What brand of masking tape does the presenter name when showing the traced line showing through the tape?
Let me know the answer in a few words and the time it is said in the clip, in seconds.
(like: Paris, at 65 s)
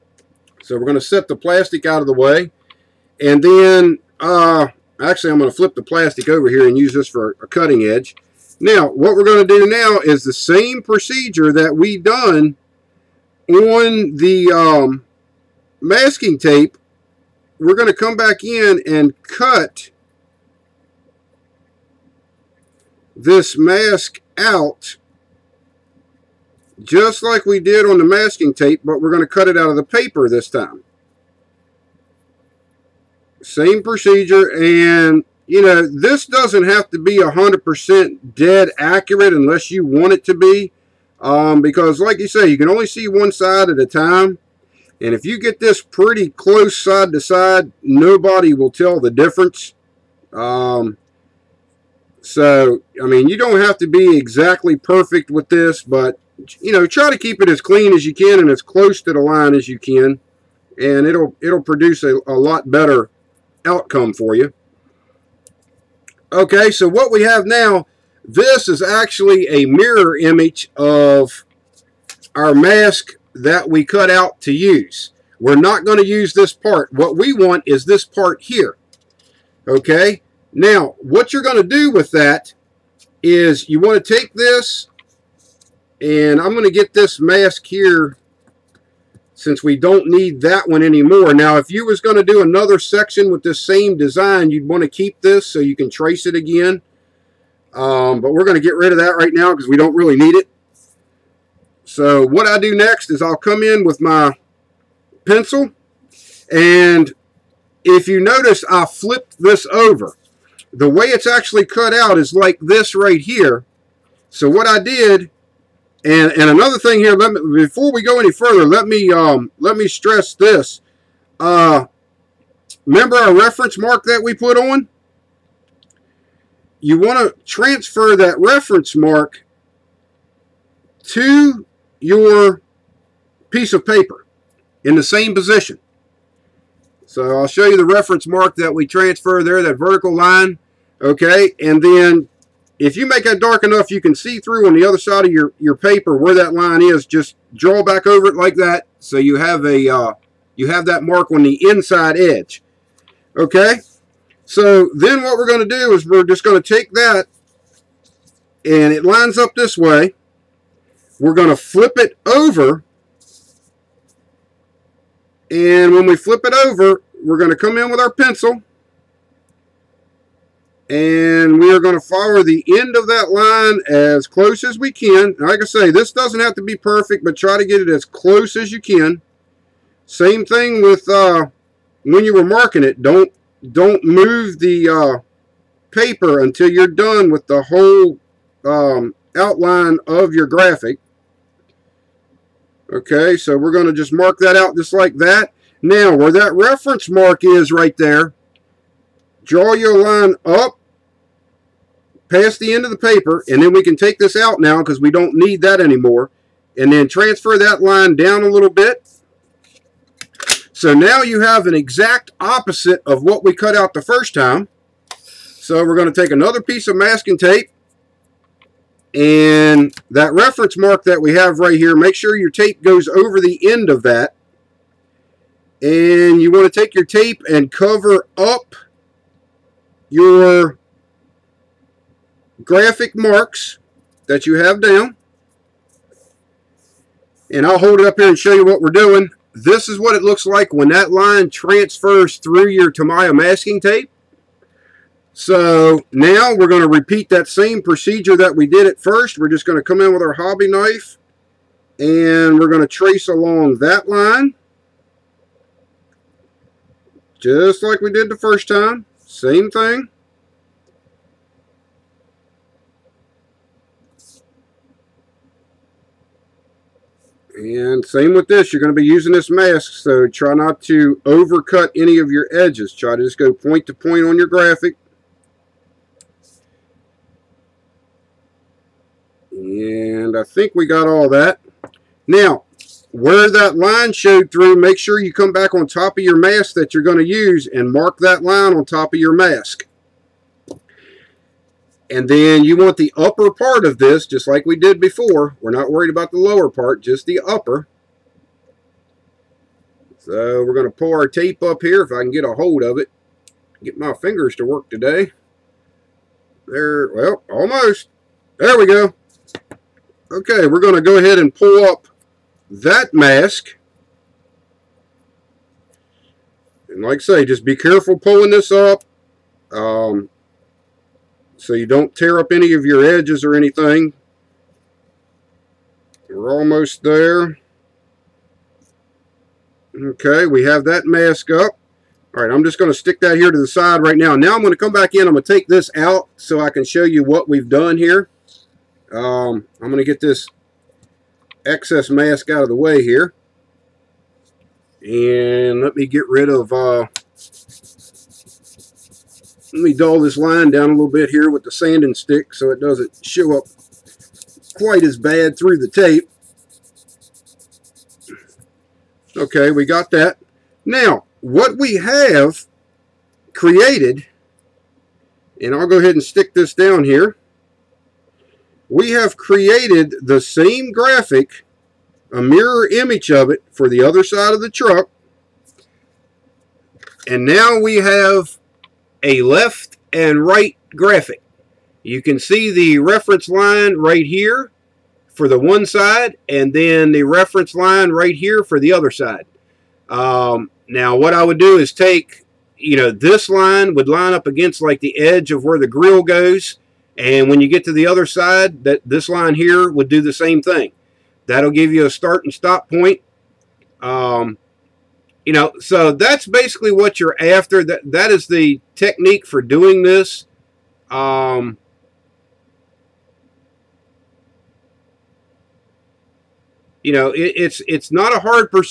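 Tamiya, at 242 s.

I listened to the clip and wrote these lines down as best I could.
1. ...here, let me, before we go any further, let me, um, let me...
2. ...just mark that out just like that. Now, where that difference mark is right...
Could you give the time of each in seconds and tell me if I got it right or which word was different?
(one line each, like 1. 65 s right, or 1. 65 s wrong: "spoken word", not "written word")
1. 116 s right
2. 193 s wrong: "reference", not "difference".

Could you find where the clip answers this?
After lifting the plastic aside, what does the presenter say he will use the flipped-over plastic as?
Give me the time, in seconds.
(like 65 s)
7 s.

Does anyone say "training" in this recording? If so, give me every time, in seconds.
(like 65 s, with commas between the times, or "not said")
not said.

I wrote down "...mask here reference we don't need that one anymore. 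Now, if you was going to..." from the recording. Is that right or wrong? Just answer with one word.
wrong.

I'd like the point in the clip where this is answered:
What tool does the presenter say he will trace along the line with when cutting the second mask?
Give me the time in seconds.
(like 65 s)
250 s.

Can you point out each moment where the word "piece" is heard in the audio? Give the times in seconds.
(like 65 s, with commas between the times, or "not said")
133 s, 216 s.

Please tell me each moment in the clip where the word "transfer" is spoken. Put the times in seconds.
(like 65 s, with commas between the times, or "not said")
127 s, 138 s, 207 s, 241 s.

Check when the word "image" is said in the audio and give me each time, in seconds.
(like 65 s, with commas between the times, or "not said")
70 s, 372 s.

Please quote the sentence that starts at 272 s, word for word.
Try to just go point to point on your graphic.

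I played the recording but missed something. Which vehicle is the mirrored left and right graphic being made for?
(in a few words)
truck.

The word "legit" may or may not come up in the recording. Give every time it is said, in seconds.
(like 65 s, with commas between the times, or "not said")
not said.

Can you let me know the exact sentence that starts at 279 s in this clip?
And I think we got all that.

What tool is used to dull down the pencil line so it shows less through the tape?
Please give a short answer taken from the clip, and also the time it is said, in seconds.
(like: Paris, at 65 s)
sanding stick, at 351 s.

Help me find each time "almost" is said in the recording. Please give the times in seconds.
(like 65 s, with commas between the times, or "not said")
307 s, 326 s.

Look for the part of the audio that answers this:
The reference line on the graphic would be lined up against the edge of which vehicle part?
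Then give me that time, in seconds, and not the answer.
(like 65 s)
395 s.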